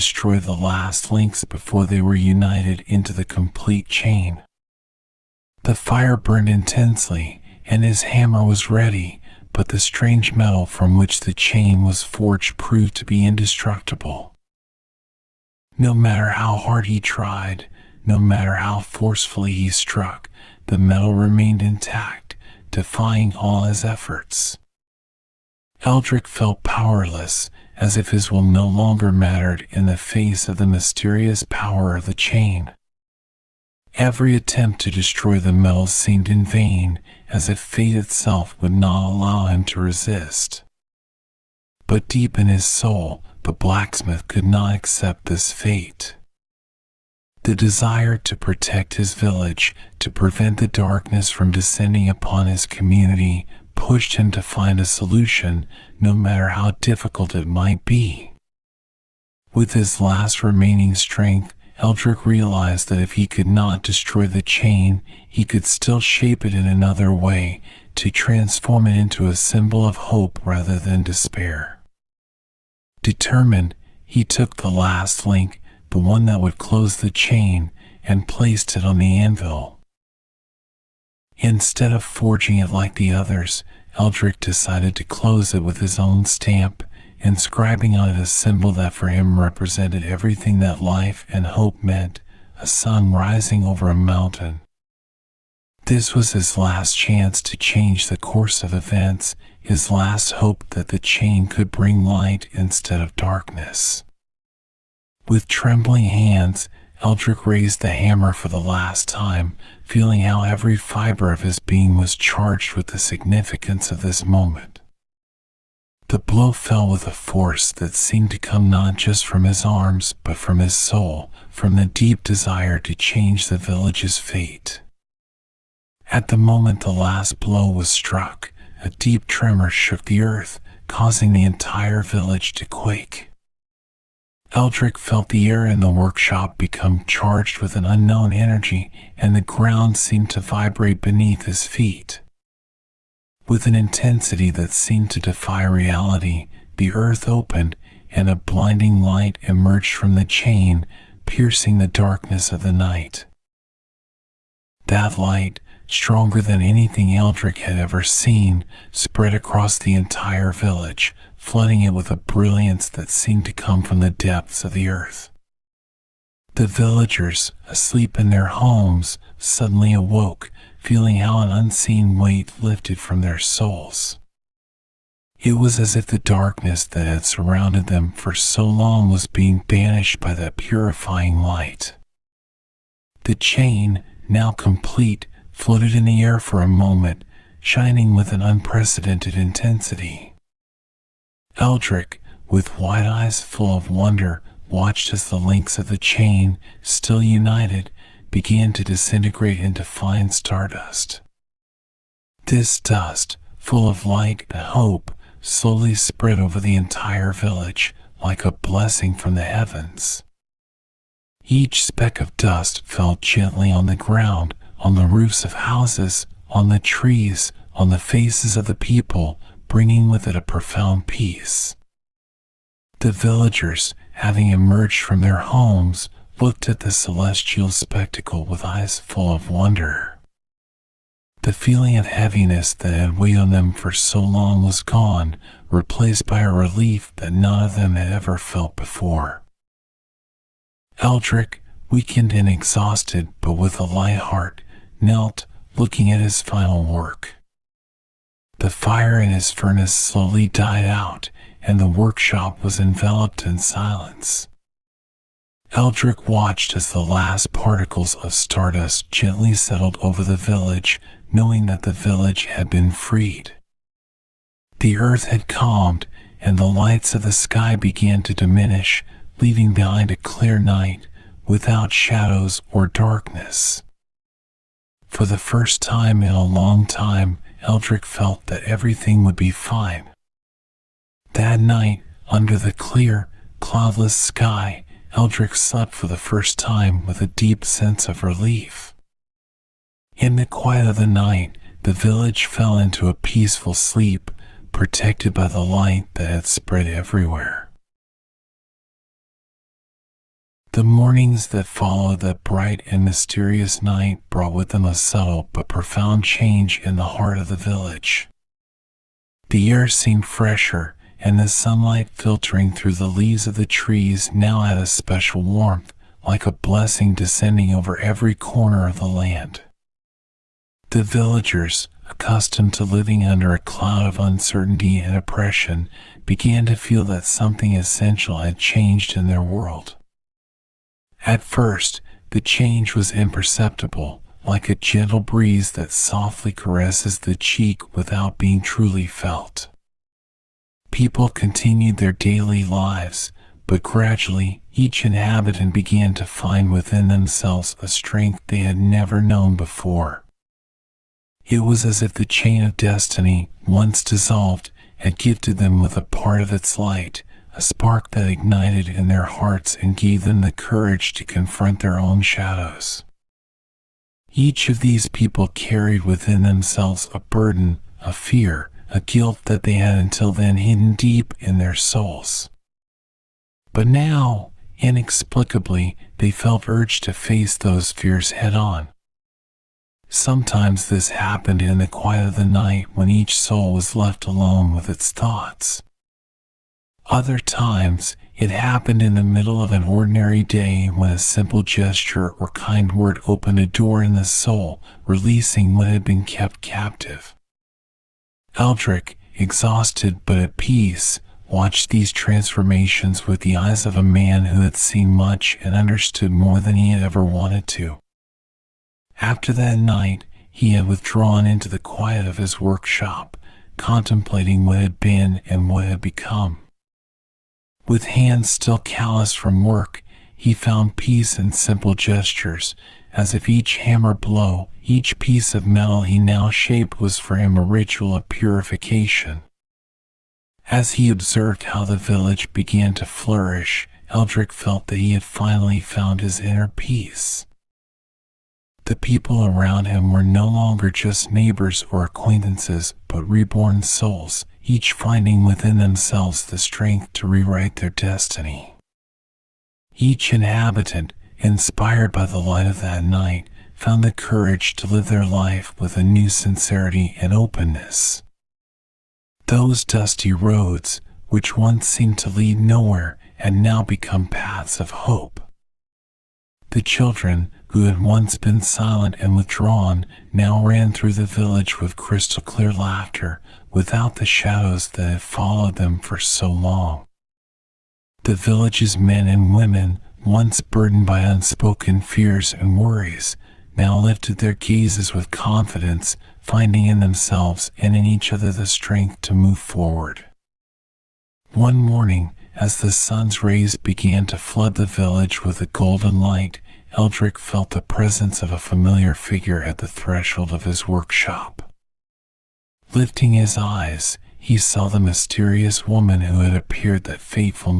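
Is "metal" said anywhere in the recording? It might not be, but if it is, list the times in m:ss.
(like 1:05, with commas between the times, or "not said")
0:10, 0:20, 0:35, 7:05.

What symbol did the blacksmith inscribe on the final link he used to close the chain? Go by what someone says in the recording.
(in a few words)
A sun rising over a mountain.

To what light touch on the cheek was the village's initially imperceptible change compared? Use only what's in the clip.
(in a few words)
A gentle breeze.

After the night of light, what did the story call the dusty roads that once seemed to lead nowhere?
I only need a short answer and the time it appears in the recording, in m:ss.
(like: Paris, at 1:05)
Paths of hope, at 7:44.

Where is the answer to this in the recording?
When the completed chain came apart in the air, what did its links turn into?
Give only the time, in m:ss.
3:19.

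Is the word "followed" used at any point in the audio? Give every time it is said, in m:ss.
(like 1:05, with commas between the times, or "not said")
5:01, 7:55.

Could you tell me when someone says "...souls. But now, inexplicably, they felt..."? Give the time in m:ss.
6:11.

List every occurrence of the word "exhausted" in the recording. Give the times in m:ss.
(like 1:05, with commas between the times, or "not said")
4:02, 6:39.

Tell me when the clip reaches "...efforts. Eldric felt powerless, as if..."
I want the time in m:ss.
0:23.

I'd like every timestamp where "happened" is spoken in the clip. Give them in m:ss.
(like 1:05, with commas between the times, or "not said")
6:21, 6:28.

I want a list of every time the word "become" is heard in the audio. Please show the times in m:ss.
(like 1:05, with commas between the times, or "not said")
2:16, 6:56, 7:43.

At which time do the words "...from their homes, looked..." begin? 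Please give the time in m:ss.
3:45.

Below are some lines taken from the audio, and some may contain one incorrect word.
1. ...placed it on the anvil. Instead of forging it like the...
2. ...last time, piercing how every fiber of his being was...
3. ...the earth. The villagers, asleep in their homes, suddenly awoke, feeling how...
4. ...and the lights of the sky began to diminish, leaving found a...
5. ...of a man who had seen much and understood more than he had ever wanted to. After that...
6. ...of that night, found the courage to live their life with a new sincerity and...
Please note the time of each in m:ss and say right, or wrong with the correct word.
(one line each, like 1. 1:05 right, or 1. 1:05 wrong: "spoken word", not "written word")
1. 1:18 right
2. 1:48 wrong: "feeling", not "piercing"
3. 2:44 right
4. 4:26 wrong: "behind", not "found"
5. 6:43 right
6. 7:32 right.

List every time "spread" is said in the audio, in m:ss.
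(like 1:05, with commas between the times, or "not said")
2:38, 3:25, 4:56.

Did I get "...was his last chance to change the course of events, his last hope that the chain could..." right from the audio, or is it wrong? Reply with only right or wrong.
right.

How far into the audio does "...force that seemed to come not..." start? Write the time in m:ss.
1:57.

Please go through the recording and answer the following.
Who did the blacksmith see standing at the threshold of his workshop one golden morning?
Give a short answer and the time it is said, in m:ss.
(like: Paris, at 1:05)
The mysterious woman, at 8:24.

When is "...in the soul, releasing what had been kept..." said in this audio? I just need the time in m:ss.
6:34.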